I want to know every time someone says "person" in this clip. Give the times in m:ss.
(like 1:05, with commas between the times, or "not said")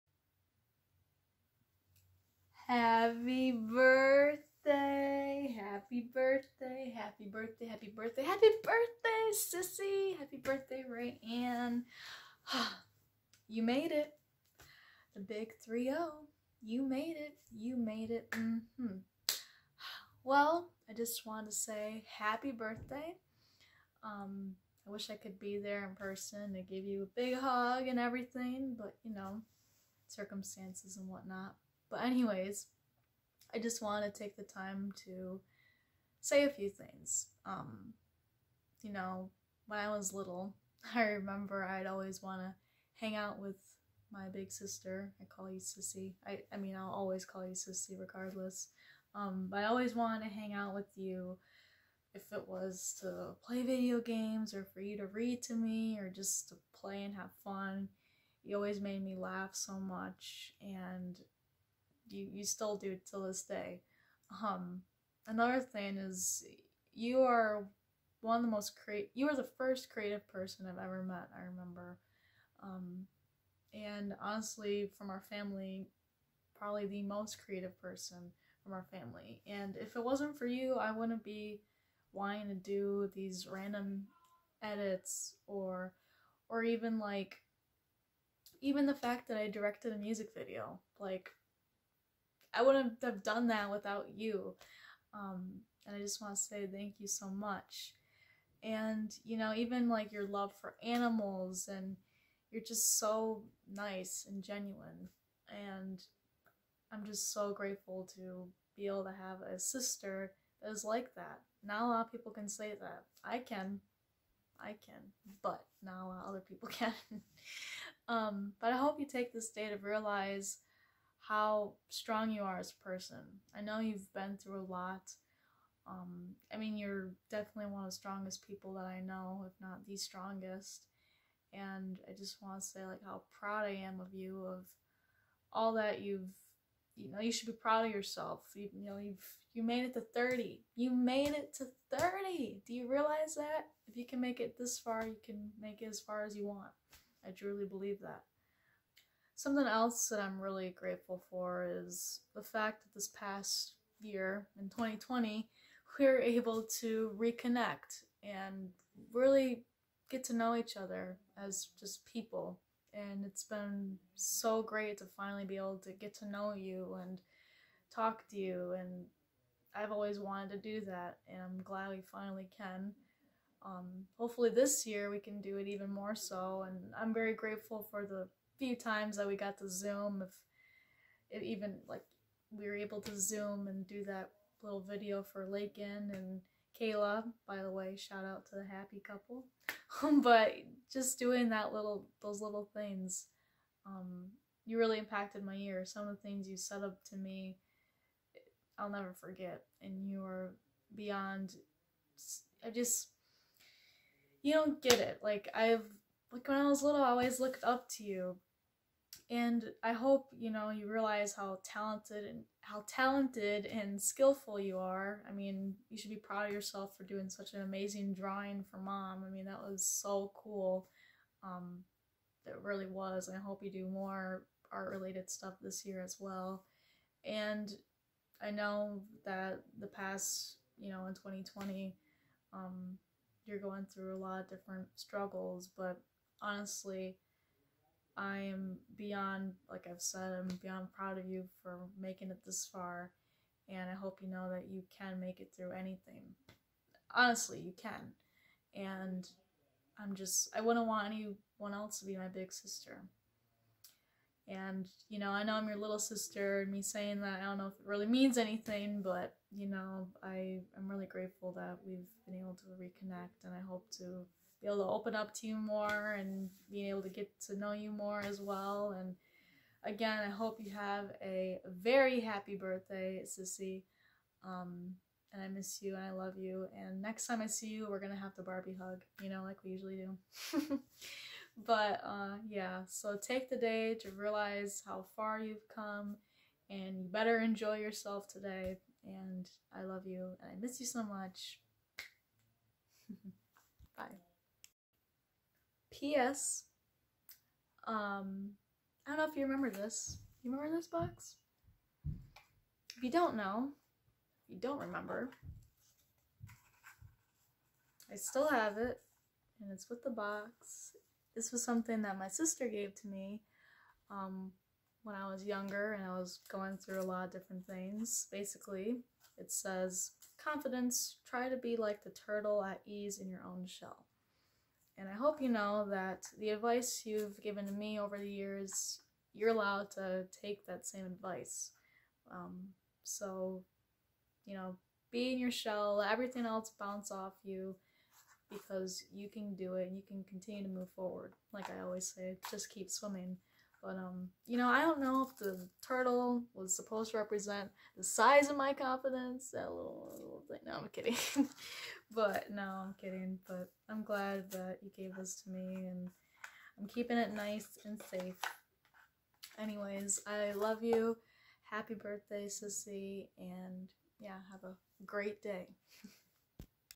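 0:25, 1:10, 1:17, 2:02.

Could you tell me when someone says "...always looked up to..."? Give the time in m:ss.
3:27.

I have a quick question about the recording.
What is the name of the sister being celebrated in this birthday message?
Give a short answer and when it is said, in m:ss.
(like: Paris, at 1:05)
Rayanne, at 0:10.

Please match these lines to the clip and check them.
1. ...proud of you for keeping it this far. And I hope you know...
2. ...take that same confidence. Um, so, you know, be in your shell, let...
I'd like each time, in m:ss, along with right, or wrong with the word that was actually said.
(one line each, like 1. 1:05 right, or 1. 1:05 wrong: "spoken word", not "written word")
1. 4:00 wrong: "making", not "keeping"
2. 5:30 wrong: "advice", not "confidence".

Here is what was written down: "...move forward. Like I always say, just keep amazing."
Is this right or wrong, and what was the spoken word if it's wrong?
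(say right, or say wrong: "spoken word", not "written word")
wrong: "swimming", not "amazing".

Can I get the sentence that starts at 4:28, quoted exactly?
And again, I hope you have a very happy birthday, Sissy.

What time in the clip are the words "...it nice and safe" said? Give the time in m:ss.
5:57.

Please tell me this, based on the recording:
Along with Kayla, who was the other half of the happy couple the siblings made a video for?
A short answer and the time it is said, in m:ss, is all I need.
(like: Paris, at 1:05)
Lakin, at 3:05.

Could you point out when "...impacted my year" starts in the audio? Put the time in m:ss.
3:14.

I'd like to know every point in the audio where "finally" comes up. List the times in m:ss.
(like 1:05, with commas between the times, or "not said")
2:45, 2:52.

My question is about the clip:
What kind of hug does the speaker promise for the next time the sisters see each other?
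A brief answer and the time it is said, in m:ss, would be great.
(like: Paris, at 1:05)
Barbie hug, at 4:38.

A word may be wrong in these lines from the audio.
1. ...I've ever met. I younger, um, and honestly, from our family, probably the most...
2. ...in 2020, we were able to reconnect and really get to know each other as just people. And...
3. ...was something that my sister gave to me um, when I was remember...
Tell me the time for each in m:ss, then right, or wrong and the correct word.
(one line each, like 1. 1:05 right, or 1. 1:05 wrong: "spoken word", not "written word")
1. 1:10 wrong: "remember", not "younger"
2. 2:34 right
3. 5:11 wrong: "younger", not "remember".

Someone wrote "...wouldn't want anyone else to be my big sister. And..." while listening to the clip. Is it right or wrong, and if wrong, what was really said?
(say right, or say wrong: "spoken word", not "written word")
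right.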